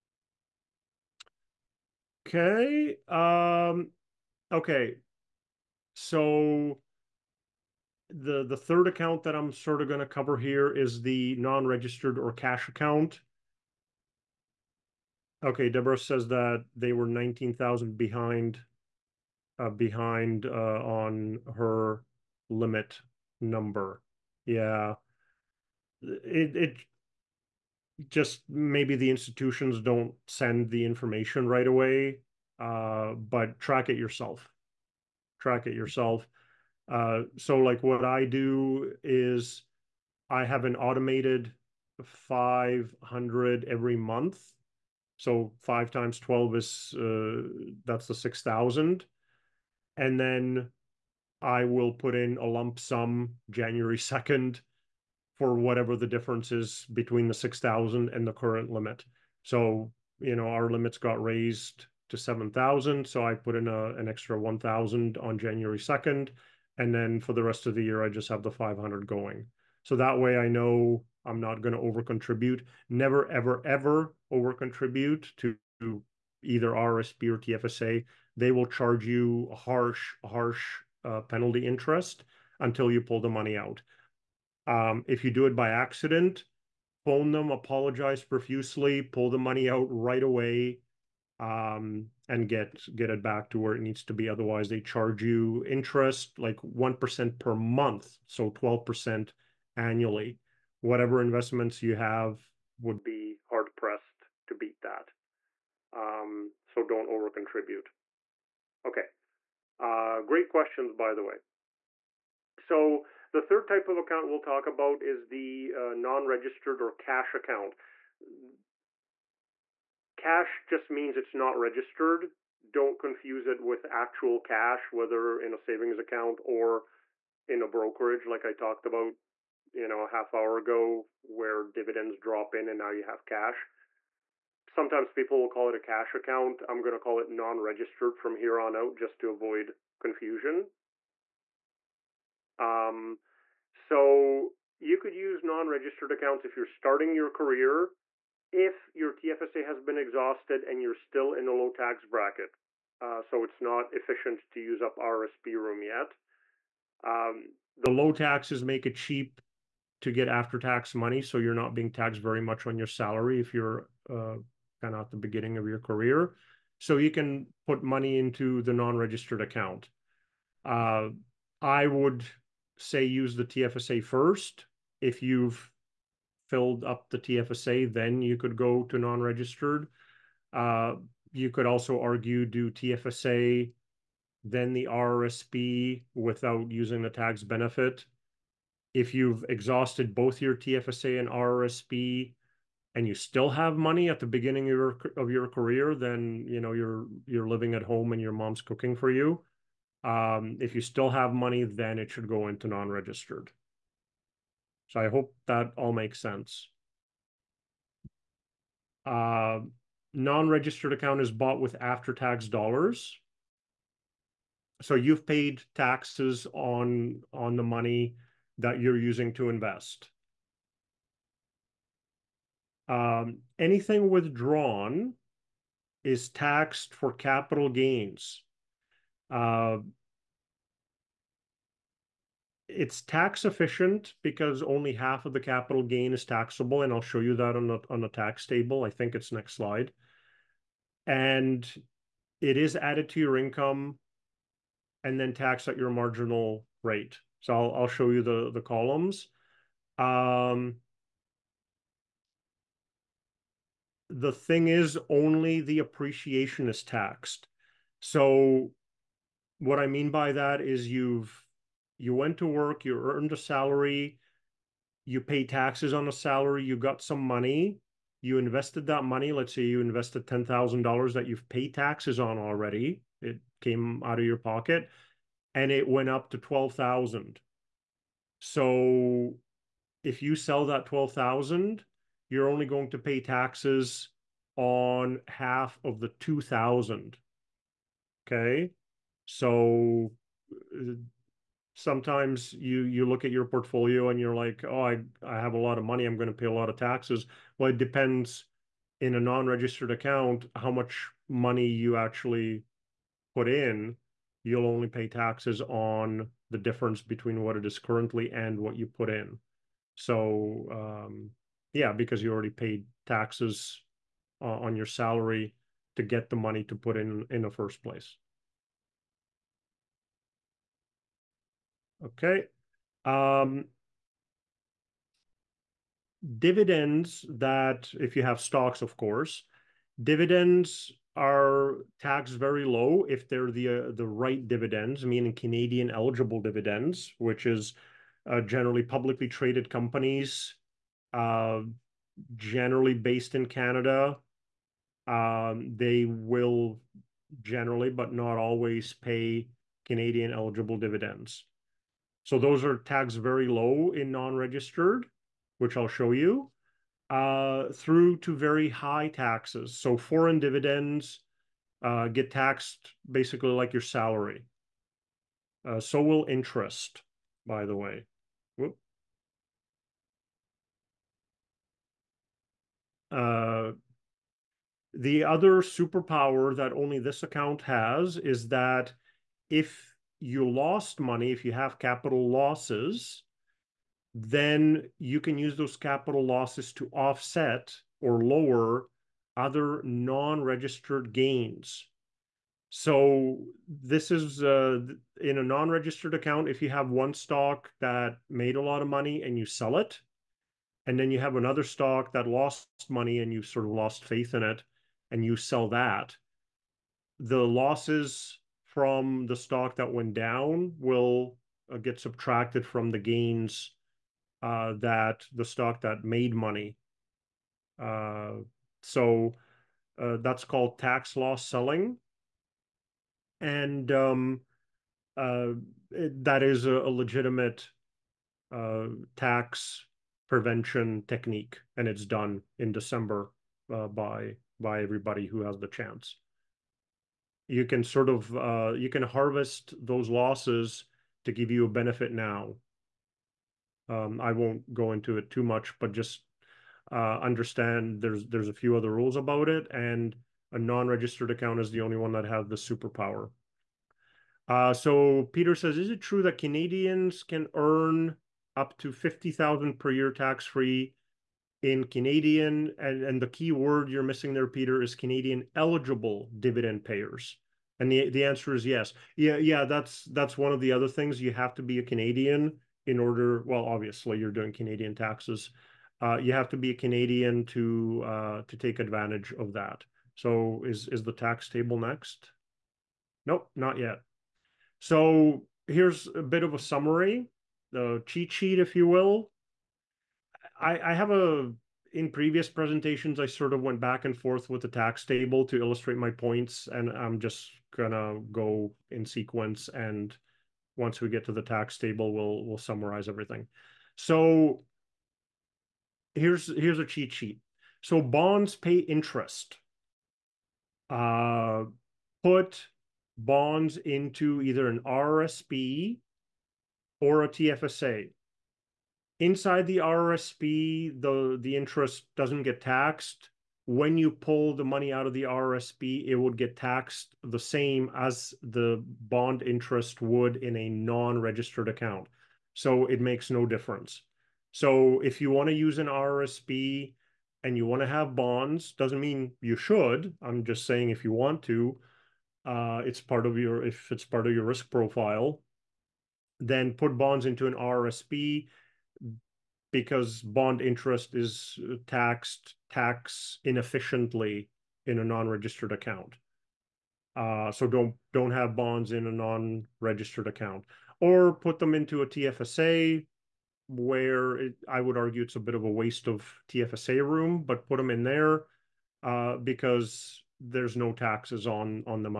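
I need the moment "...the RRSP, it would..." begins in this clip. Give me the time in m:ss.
8:45.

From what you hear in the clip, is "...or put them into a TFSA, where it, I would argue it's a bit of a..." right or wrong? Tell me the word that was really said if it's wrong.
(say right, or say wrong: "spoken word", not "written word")
right.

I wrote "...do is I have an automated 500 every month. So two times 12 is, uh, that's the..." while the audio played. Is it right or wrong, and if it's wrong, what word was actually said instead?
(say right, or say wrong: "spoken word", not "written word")
wrong: "five", not "two".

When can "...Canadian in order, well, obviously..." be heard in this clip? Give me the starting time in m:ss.
7:51.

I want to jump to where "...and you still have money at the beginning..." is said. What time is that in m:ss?
3:12.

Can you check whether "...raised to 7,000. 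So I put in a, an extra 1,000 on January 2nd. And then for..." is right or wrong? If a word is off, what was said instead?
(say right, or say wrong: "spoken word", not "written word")
right.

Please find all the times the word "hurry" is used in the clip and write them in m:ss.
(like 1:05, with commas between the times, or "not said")
not said.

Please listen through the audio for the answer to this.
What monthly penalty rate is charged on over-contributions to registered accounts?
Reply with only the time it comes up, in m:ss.
1:36.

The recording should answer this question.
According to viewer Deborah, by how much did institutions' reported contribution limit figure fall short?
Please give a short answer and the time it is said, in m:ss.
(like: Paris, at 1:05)
19,000, at 0:17.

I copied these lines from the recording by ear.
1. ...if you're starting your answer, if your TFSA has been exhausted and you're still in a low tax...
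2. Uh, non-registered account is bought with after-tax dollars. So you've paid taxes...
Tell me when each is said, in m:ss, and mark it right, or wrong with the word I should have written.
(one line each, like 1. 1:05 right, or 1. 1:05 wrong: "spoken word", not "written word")
1. 2:26 wrong: "career", not "answer"
2. 3:29 right.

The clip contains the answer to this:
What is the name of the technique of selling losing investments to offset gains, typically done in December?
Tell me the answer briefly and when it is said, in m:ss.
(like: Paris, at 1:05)
Tax loss selling, at 7:00.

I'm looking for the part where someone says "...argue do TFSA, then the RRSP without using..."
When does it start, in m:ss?
3:01.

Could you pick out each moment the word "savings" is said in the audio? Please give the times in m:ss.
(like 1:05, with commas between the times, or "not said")
2:05.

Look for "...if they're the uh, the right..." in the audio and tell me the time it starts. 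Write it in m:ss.
5:33.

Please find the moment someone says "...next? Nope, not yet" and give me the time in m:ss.
8:01.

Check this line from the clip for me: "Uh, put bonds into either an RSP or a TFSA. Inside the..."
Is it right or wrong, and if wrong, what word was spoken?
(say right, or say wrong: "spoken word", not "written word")
right.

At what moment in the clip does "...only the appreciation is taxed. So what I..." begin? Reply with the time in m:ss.
4:15.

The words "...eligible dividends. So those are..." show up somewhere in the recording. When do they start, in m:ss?
5:50.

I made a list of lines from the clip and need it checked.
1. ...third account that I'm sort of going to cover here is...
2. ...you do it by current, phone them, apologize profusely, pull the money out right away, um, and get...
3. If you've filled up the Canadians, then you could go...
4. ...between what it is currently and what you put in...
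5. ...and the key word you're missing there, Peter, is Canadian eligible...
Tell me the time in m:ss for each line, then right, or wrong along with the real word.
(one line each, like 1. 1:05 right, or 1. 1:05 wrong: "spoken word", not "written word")
1. 0:08 right
2. 1:25 wrong: "accident", not "current"
3. 2:55 wrong: "TFSA", not "Canadians"
4. 5:06 right
5. 7:43 right.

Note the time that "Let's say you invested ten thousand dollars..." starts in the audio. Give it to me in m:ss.
4:29.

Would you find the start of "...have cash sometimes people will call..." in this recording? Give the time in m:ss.
2:13.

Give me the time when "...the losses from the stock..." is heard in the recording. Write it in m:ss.
6:47.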